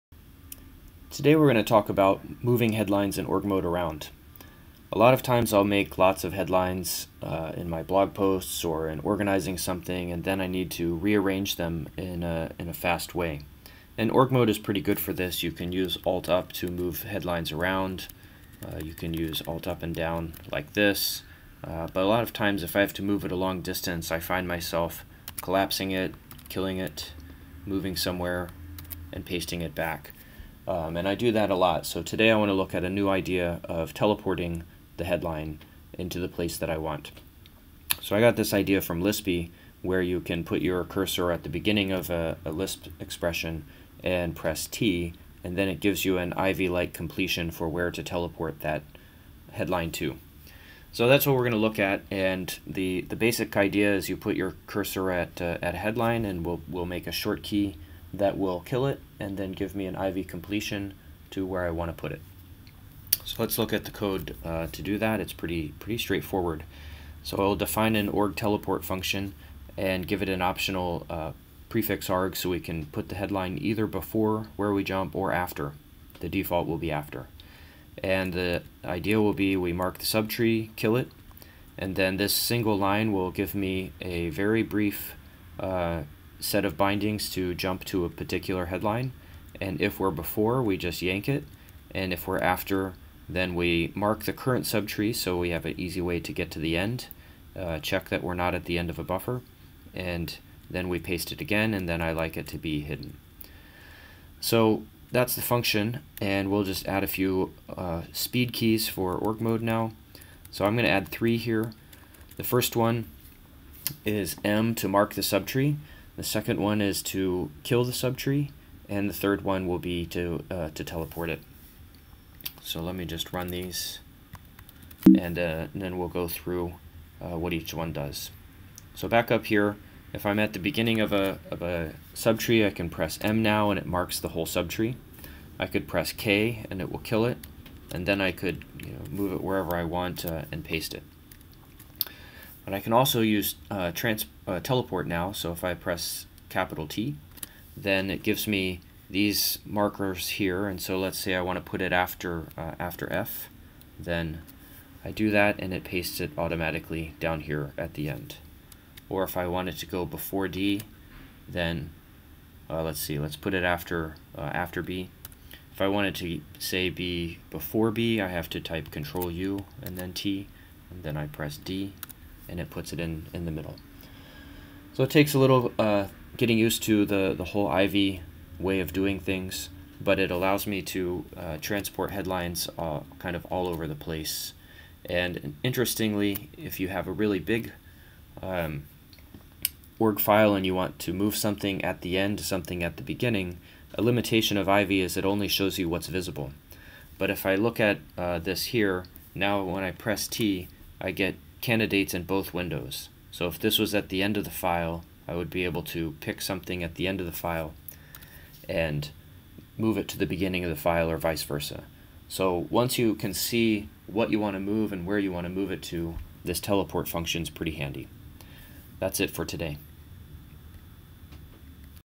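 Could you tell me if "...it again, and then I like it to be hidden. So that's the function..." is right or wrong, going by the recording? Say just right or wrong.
right.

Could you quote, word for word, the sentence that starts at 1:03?
So let's look at the code uh, to do that.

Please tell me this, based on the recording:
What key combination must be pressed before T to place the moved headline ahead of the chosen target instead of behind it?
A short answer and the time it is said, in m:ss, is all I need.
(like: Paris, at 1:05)
Control U, at 2:48.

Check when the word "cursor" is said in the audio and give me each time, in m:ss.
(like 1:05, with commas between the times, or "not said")
0:40, 0:54.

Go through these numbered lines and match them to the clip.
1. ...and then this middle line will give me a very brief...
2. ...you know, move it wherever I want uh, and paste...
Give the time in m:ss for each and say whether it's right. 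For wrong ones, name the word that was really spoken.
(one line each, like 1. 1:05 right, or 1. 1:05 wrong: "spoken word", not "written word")
1. 1:21 wrong: "single", not "middle"
2. 2:18 right.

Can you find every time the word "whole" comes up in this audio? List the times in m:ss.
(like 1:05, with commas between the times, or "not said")
2:14, 2:57.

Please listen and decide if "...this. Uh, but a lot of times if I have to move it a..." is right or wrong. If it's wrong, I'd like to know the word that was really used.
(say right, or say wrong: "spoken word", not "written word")
right.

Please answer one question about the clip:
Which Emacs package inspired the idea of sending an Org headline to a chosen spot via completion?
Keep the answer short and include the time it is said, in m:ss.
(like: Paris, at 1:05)
Lispy, at 0:39.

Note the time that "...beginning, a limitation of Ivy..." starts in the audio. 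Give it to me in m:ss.
3:13.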